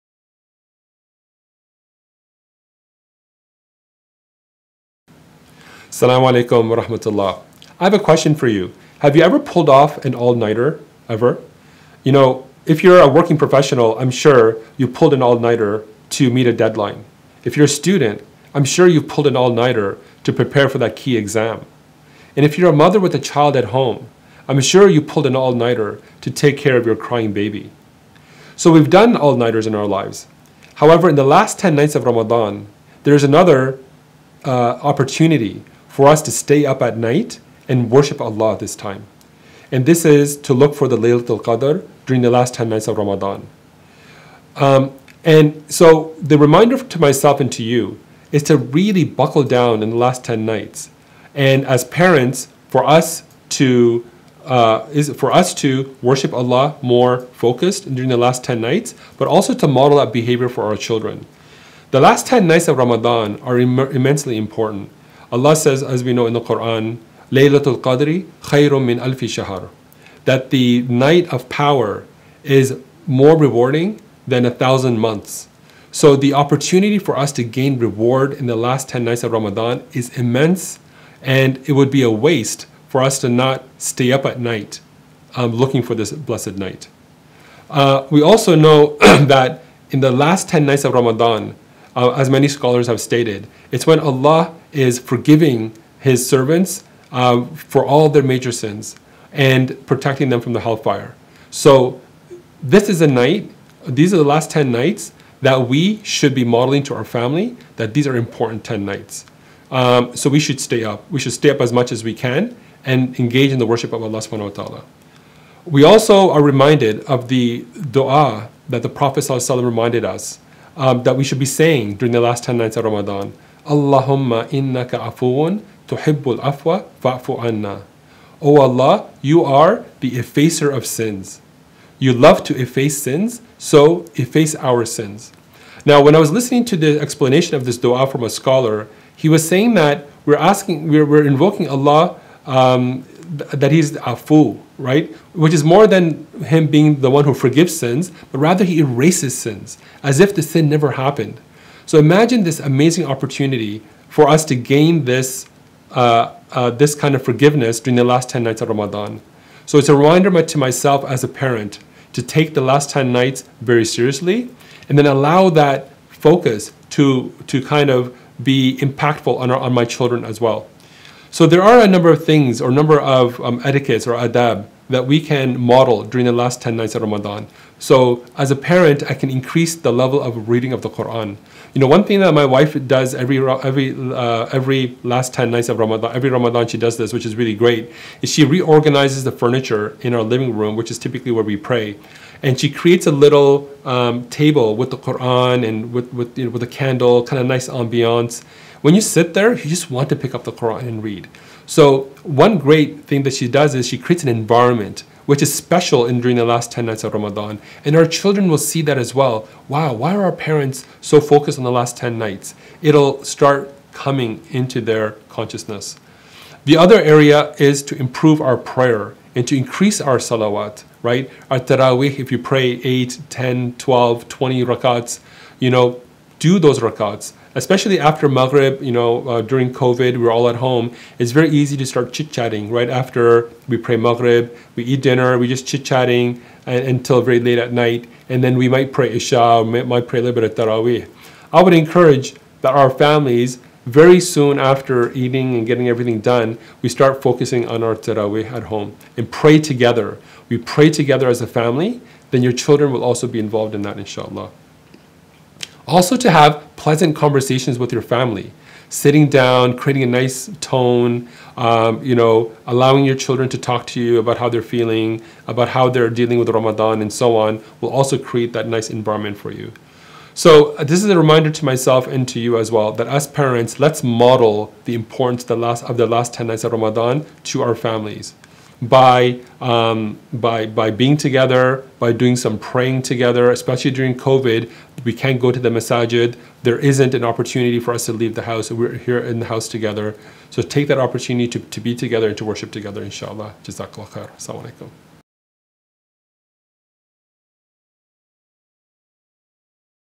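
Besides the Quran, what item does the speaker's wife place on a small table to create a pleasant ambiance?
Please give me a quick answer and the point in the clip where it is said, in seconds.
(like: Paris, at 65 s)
a candle, at 196 s.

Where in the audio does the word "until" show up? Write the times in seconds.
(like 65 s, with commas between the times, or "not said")
236 s.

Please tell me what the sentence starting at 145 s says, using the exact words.
Which is more than him being the one who forgives sins, but rather he erases sins as if the sin never happened.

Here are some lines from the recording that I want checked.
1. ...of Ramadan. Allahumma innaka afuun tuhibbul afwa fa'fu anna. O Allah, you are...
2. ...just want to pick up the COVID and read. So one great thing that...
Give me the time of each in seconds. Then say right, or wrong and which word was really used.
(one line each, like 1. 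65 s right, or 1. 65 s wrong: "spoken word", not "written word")
1. 122 s right
2. 199 s wrong: "Quran", not "COVID".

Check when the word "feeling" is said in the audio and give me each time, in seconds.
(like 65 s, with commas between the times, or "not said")
264 s.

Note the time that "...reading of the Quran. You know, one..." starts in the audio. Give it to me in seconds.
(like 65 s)
180 s.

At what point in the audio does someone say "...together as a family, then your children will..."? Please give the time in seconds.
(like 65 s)
250 s.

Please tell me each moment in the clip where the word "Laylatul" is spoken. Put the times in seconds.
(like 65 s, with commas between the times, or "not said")
40 s, 67 s.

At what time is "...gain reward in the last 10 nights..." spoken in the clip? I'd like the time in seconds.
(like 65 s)
77 s.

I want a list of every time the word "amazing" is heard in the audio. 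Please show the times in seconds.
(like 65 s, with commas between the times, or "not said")
152 s.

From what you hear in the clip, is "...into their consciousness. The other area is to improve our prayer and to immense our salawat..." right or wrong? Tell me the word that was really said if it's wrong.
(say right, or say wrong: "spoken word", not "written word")
wrong: "increase", not "immense".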